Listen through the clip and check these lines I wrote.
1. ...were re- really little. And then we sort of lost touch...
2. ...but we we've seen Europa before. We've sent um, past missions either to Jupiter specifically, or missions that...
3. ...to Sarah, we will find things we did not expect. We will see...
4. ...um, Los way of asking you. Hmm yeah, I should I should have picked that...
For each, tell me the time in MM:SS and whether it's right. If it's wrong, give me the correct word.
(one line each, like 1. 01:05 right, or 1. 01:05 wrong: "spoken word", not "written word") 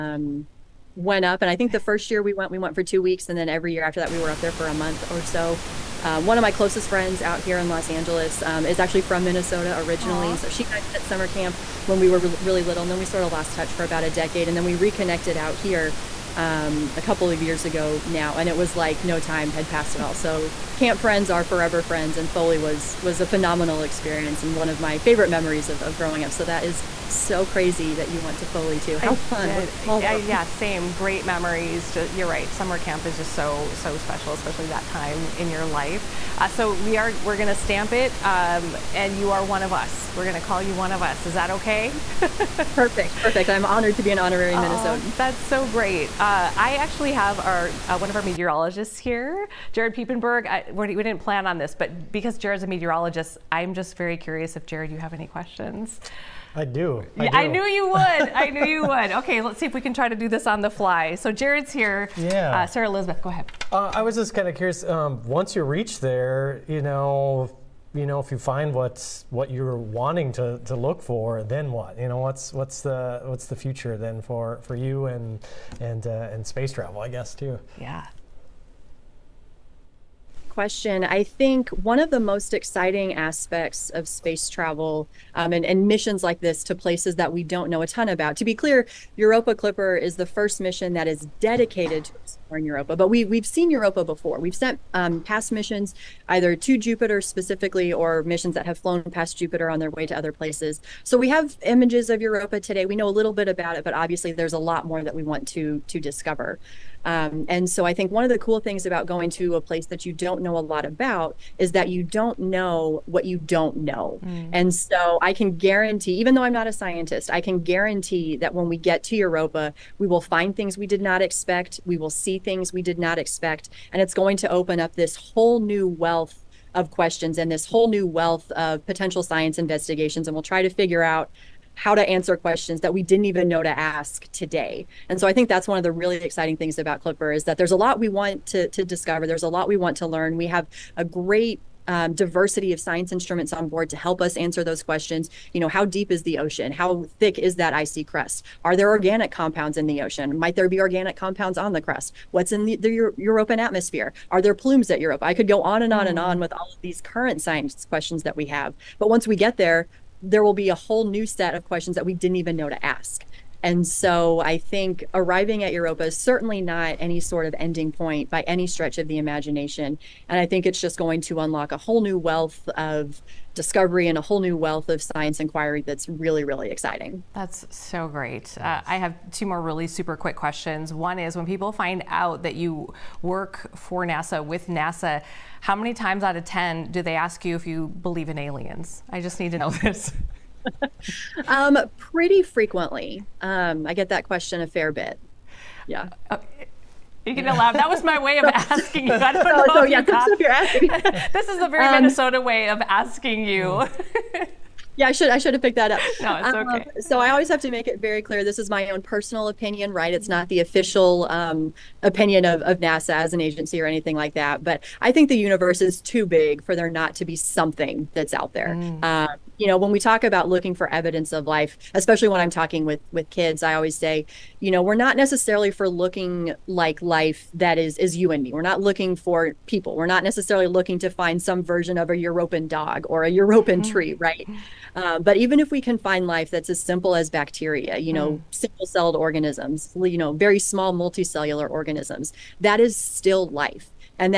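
1. 00:12 right
2. 01:32 right
3. 01:59 wrong: "Europa", not "Sarah"
4. 03:21 wrong: "Minnesota", not "Los".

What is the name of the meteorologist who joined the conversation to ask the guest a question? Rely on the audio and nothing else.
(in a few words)
Jared Piepenberg.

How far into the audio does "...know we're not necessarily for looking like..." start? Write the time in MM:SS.
03:44.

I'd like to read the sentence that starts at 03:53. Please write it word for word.
tree right uh, but even if we can find life that's as simple as bacteria, you know, mm.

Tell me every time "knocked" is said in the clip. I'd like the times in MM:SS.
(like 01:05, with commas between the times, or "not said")
not said.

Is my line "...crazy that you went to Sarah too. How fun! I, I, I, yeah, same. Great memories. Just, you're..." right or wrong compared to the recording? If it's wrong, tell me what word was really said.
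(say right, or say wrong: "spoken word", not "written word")
wrong: "Foley", not "Sarah".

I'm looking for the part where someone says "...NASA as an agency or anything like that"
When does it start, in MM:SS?
03:32.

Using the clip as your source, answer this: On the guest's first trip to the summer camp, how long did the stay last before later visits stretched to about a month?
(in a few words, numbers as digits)
2 weeks.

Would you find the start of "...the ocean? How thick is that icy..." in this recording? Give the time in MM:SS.
02:26.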